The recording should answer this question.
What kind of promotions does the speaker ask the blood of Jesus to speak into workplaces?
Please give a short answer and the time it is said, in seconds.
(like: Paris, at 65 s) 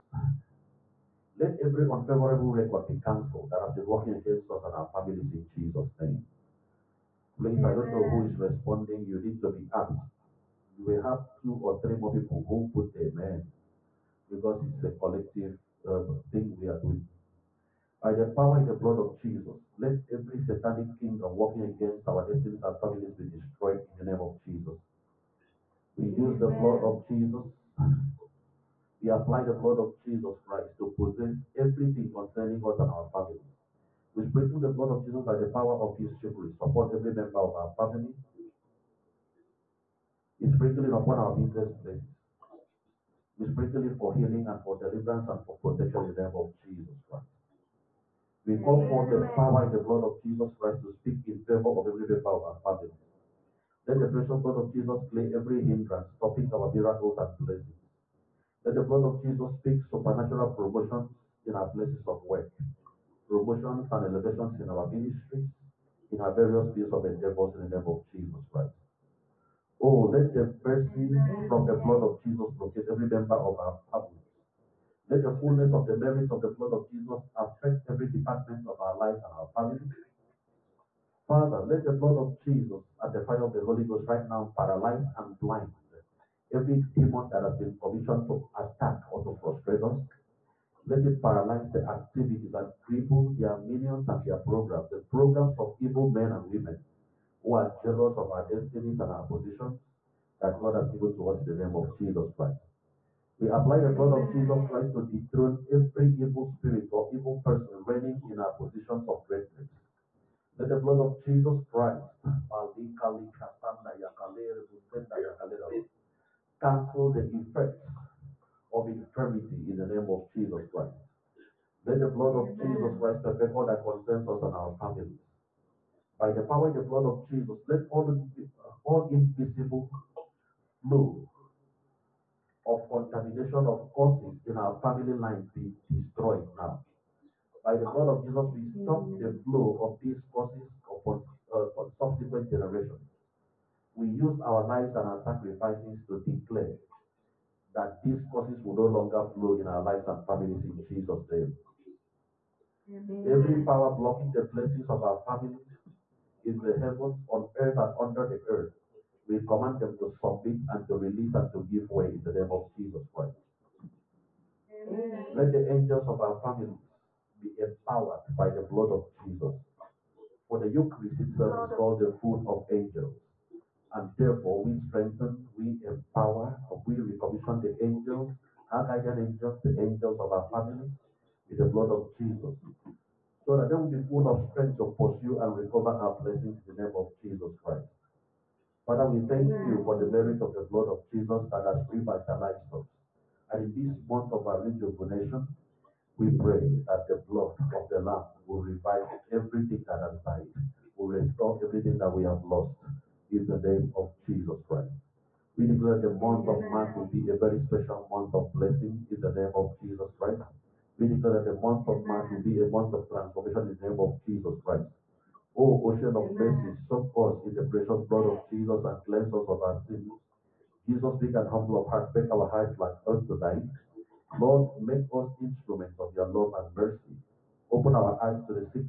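Supernatural promotions, at 59 s.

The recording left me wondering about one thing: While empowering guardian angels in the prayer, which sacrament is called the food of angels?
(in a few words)
The Eucharist.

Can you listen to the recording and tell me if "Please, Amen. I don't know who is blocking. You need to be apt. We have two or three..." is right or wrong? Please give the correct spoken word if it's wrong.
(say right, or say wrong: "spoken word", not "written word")
wrong: "responding", not "blocking".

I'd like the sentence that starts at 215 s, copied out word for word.
O ocean of mercy, soak us in the precious blood of Jesus and cleanse us of our sins.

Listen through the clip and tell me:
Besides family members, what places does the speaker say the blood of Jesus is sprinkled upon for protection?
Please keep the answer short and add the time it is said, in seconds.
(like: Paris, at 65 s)
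Business places, at 41 s.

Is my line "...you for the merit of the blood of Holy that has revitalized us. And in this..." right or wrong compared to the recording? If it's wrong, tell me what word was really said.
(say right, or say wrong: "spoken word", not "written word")
wrong: "Jesus", not "Holy".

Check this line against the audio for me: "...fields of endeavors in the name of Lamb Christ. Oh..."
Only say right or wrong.
wrong.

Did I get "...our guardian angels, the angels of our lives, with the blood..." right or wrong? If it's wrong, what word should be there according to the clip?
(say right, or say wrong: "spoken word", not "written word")
wrong: "families", not "lives".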